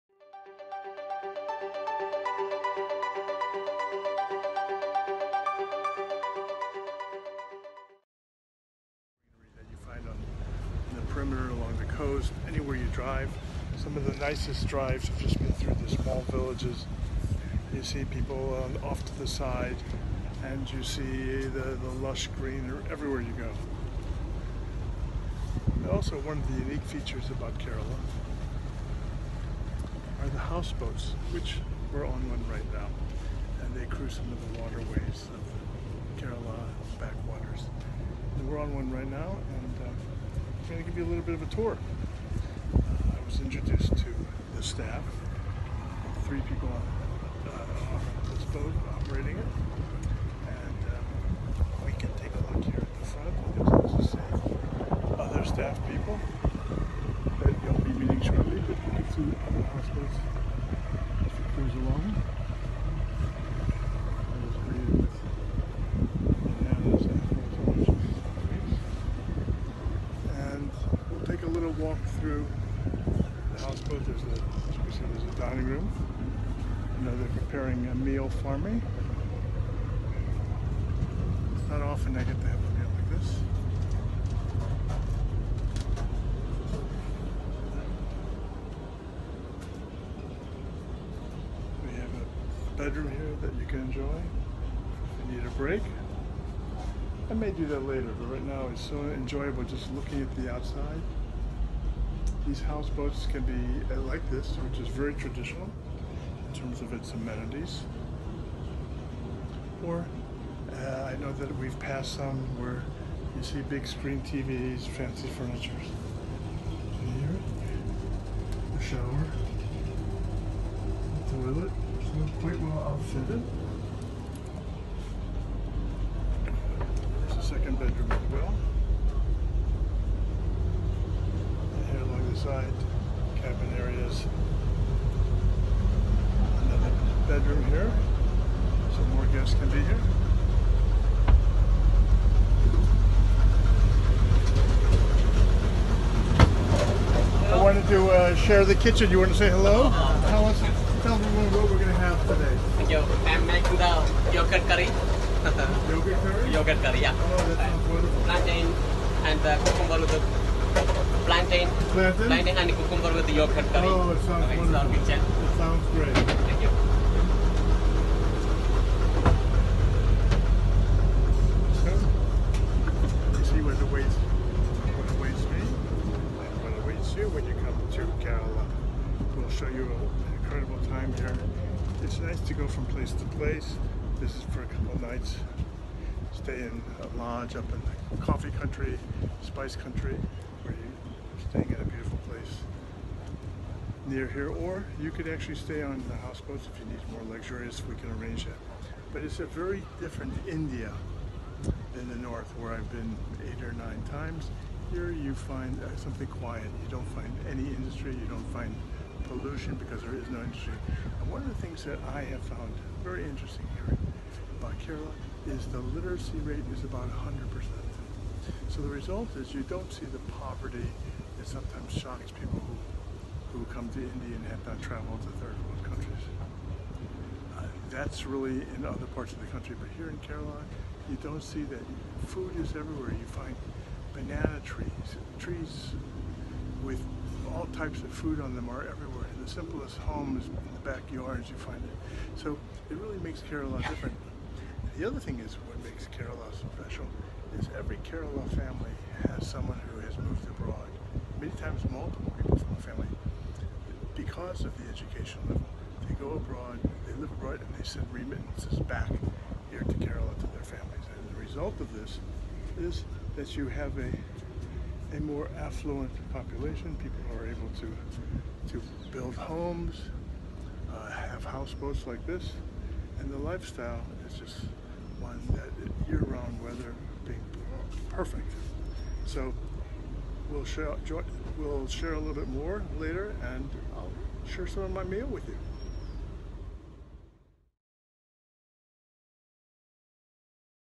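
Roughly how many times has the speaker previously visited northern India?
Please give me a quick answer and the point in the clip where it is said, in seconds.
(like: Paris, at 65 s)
8 or 9, at 203 s.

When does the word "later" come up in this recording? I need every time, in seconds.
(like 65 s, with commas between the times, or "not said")
97 s, 282 s.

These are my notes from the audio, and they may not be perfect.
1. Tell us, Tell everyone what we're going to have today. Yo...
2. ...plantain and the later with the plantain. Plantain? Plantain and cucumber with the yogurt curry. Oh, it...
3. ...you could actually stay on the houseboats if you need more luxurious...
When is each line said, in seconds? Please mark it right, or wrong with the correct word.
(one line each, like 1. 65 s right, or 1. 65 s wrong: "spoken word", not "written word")
1. 150 s right
2. 158 s wrong: "cucumber", not "later"
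3. 194 s right.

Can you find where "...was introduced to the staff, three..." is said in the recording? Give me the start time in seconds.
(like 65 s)
43 s.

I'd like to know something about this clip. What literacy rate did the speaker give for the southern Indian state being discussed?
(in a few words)
About 100%.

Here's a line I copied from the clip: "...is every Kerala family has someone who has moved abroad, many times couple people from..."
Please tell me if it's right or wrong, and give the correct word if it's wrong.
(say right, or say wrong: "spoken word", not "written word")
wrong: "multiple", not "couple".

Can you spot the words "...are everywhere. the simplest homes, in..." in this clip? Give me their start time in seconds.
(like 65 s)
238 s.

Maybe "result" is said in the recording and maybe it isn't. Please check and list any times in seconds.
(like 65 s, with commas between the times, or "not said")
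218 s, 261 s.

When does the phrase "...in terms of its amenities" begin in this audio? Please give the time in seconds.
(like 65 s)
106 s.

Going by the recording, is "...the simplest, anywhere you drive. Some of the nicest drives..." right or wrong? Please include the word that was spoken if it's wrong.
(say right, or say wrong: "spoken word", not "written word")
wrong: "coast", not "simplest".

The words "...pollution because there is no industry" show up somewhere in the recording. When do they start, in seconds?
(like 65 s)
209 s.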